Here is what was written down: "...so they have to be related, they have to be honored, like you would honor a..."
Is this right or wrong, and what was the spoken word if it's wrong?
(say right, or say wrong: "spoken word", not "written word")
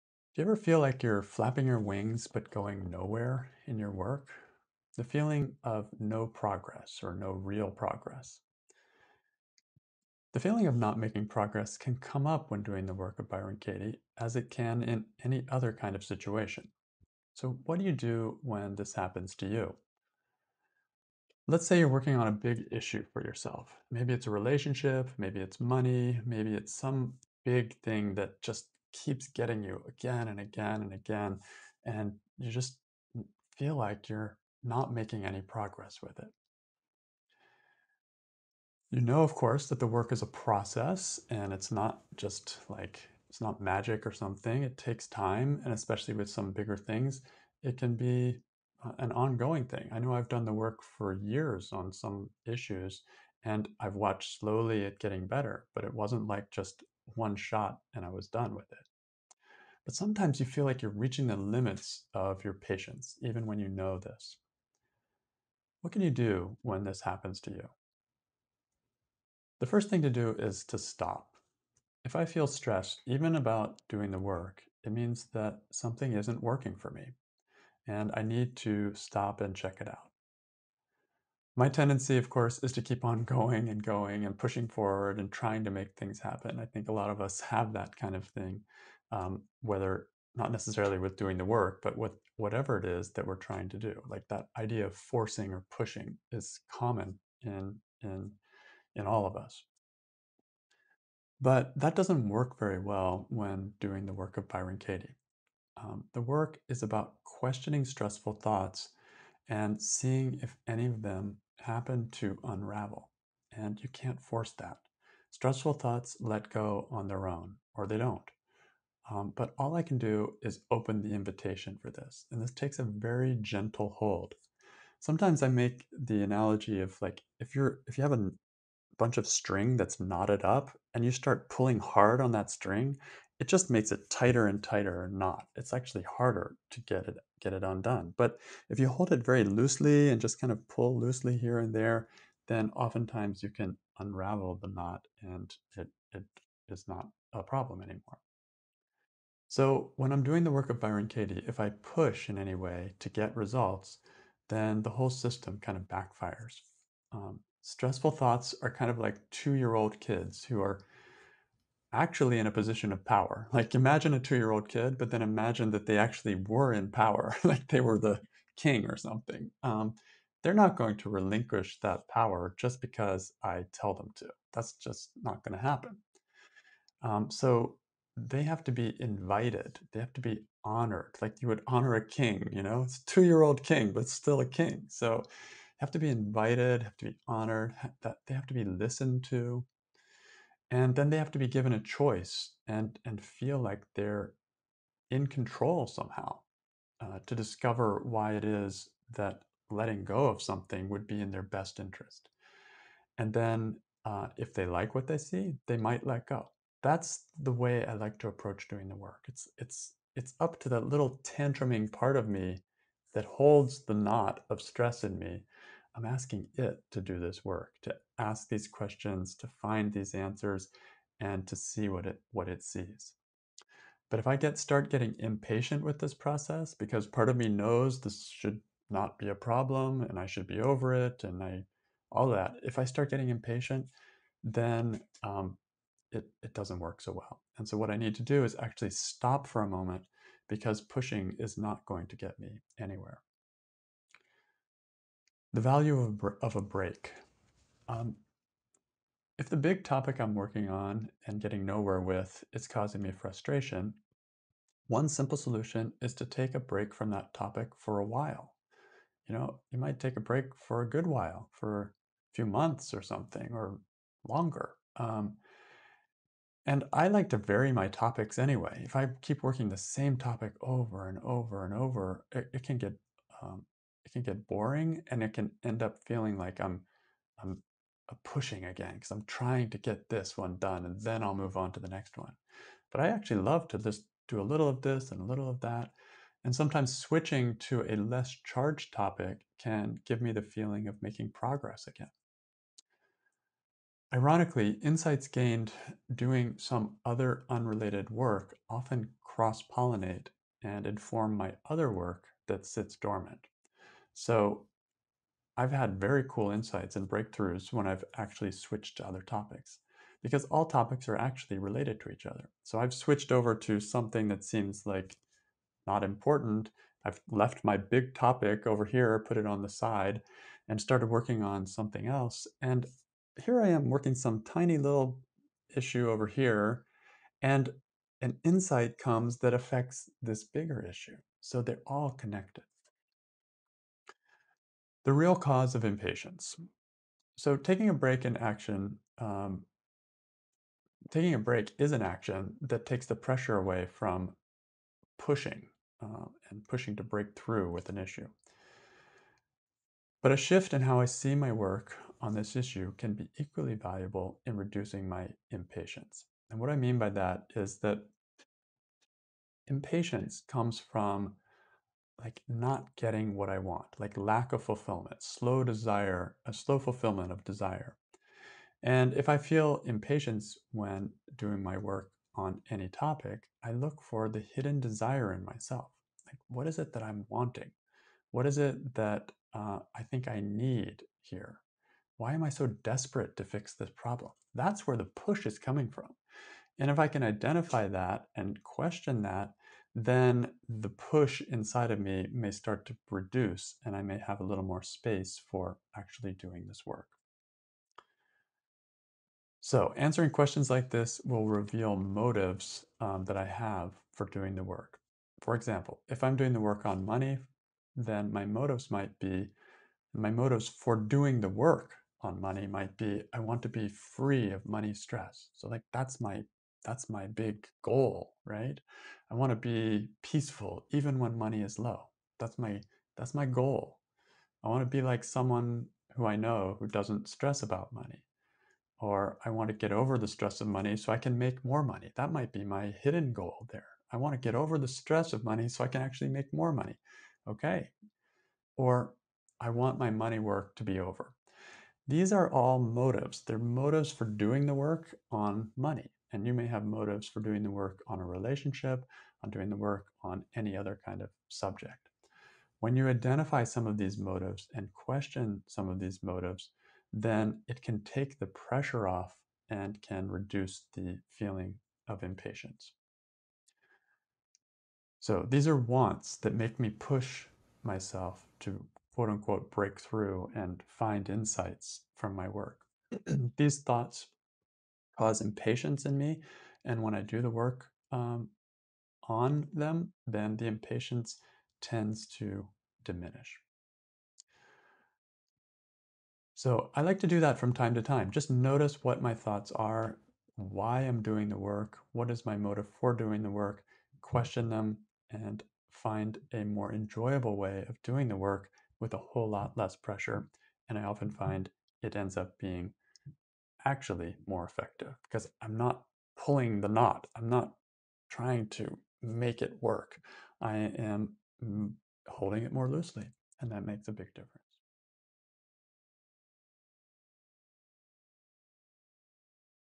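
wrong: "invited", not "related".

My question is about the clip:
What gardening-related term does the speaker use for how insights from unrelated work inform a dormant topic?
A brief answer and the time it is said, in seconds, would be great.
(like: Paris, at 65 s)
Cross pollinate, at 299 s.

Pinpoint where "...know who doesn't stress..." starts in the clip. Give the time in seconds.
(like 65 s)
426 s.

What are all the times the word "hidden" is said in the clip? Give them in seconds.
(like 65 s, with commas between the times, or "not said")
374 s, 433 s.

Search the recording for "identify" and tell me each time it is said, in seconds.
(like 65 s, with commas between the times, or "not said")
387 s, 453 s.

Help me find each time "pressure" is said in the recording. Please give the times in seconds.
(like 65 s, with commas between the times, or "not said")
343 s, 458 s, 499 s.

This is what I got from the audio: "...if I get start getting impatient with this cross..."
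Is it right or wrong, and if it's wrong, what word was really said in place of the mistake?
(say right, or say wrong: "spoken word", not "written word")
wrong: "process", not "cross".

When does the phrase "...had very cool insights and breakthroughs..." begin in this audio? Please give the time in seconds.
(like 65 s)
305 s.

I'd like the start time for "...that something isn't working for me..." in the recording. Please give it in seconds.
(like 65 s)
75 s.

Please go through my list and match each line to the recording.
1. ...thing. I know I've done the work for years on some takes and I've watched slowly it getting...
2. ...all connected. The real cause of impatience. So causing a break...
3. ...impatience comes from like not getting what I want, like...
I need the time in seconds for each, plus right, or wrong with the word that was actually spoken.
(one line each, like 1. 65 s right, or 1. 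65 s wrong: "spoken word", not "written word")
1. 49 s wrong: "issues", not "takes"
2. 331 s wrong: "taking", not "causing"
3. 359 s right.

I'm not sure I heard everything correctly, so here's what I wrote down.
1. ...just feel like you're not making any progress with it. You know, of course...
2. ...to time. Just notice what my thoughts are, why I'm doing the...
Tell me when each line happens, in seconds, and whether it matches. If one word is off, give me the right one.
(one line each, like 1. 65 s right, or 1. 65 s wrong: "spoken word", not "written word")
1. 32 s right
2. 487 s right.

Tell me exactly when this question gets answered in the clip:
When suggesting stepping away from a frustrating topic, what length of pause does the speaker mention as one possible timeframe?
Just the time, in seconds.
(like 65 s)
262 s.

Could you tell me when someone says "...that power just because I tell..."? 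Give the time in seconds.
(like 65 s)
171 s.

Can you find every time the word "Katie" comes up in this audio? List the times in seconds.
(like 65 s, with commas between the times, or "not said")
13 s, 104 s, 151 s.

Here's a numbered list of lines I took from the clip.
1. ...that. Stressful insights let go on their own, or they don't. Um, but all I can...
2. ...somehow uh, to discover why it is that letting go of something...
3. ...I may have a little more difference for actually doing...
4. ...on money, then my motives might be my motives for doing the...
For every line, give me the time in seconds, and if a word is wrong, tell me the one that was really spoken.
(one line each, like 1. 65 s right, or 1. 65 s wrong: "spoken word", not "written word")
1. 114 s wrong: "thoughts", not "insights"
2. 195 s right
3. 393 s wrong: "space", not "difference"
4. 406 s right.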